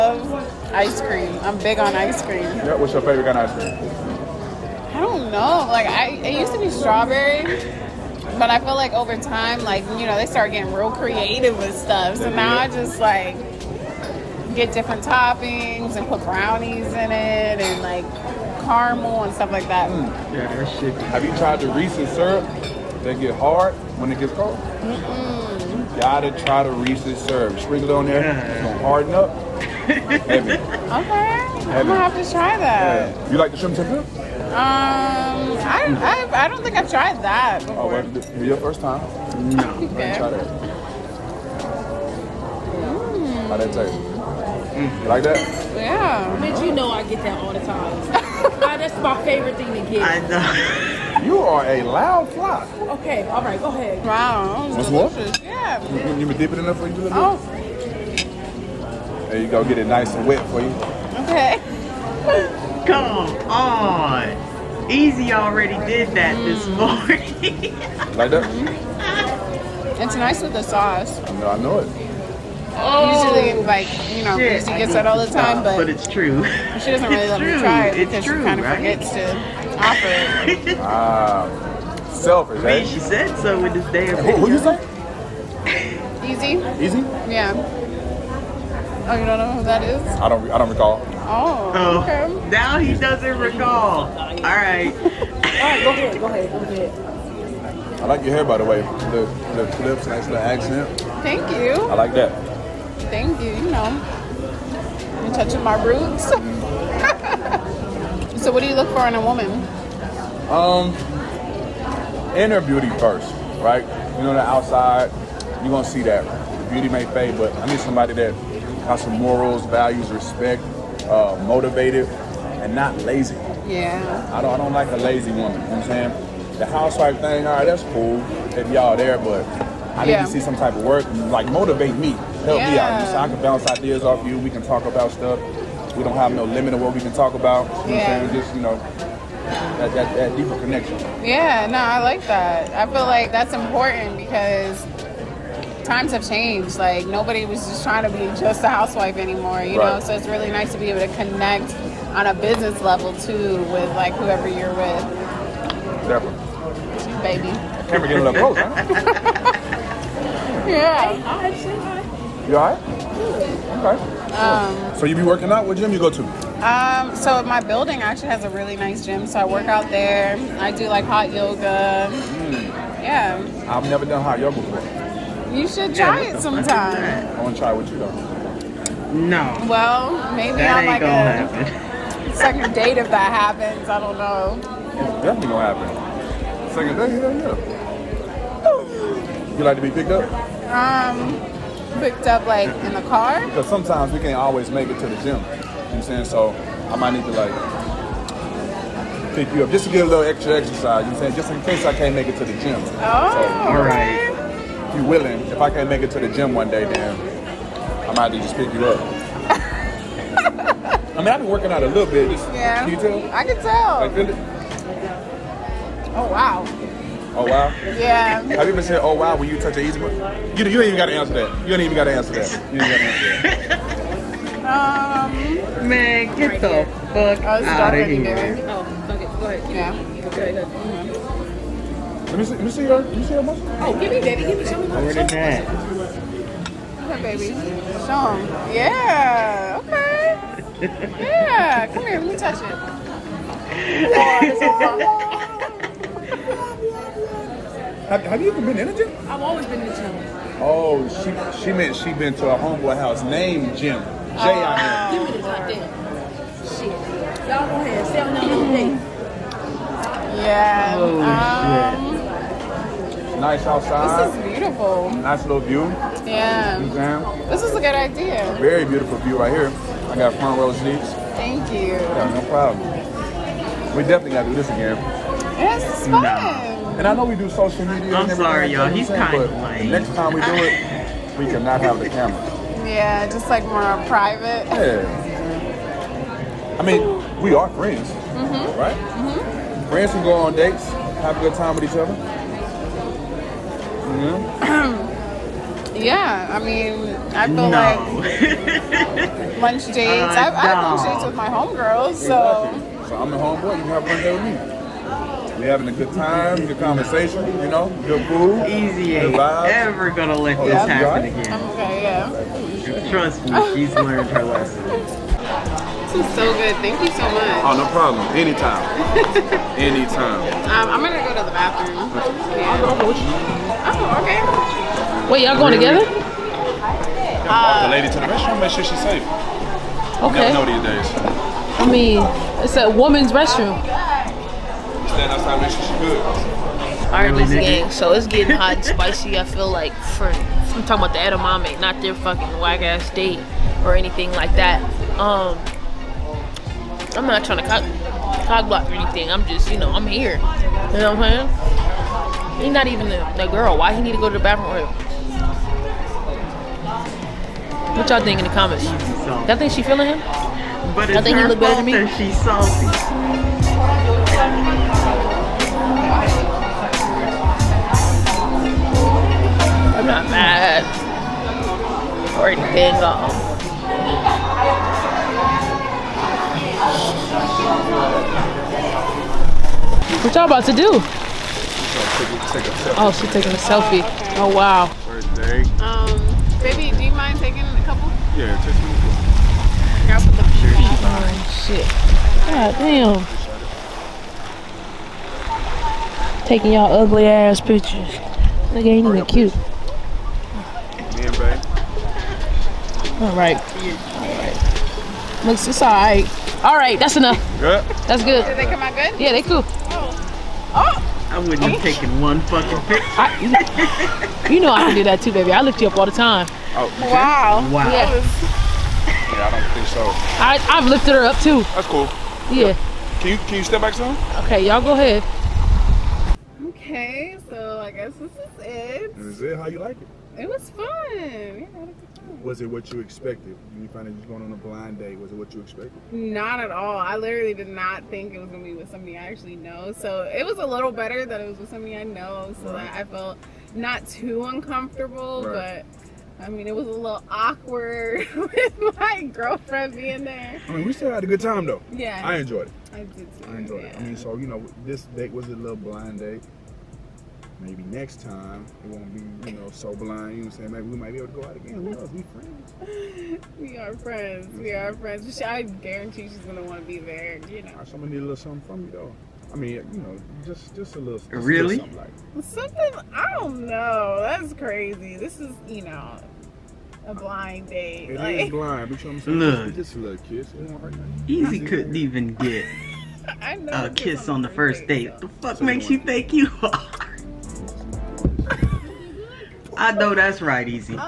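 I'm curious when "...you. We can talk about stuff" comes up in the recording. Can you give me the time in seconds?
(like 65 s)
134 s.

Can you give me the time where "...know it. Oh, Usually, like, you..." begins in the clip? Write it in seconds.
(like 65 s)
71 s.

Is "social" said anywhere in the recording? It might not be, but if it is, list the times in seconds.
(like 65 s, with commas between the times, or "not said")
277 s.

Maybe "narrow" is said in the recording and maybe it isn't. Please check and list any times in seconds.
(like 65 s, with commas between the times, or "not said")
not said.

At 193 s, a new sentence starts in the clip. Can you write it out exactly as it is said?
Because sometimes we can't always make it to the gym.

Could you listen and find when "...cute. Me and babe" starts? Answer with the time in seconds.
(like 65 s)
399 s.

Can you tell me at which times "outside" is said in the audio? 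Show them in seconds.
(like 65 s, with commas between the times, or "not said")
114 s, 263 s, 335 s.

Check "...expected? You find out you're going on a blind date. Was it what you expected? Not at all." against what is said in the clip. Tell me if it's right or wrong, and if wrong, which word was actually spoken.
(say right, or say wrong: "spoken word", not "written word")
right.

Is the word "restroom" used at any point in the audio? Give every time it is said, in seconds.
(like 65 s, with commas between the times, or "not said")
328 s, 333 s.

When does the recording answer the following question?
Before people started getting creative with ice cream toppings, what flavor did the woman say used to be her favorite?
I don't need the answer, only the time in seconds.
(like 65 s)
6 s.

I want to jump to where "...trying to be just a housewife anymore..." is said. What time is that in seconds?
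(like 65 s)
147 s.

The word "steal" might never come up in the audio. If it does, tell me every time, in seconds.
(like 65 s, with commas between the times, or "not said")
not said.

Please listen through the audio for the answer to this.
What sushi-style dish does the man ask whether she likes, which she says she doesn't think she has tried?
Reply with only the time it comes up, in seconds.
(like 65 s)
33 s.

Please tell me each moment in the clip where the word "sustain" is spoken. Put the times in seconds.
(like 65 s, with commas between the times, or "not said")
not said.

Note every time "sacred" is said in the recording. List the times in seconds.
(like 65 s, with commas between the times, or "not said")
not said.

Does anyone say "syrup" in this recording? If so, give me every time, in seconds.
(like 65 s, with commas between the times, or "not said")
22 s, 27 s.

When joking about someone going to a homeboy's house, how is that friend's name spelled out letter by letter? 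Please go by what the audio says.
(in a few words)
J I M.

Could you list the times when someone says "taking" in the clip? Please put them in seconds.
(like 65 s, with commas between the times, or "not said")
383 s, 387 s, 396 s.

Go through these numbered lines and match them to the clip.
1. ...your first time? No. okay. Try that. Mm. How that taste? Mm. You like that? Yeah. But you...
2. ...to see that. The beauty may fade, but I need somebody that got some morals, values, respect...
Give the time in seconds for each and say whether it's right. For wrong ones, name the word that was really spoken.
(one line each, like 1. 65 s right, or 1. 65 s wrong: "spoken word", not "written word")
1. 38 s right
2. 115 s right.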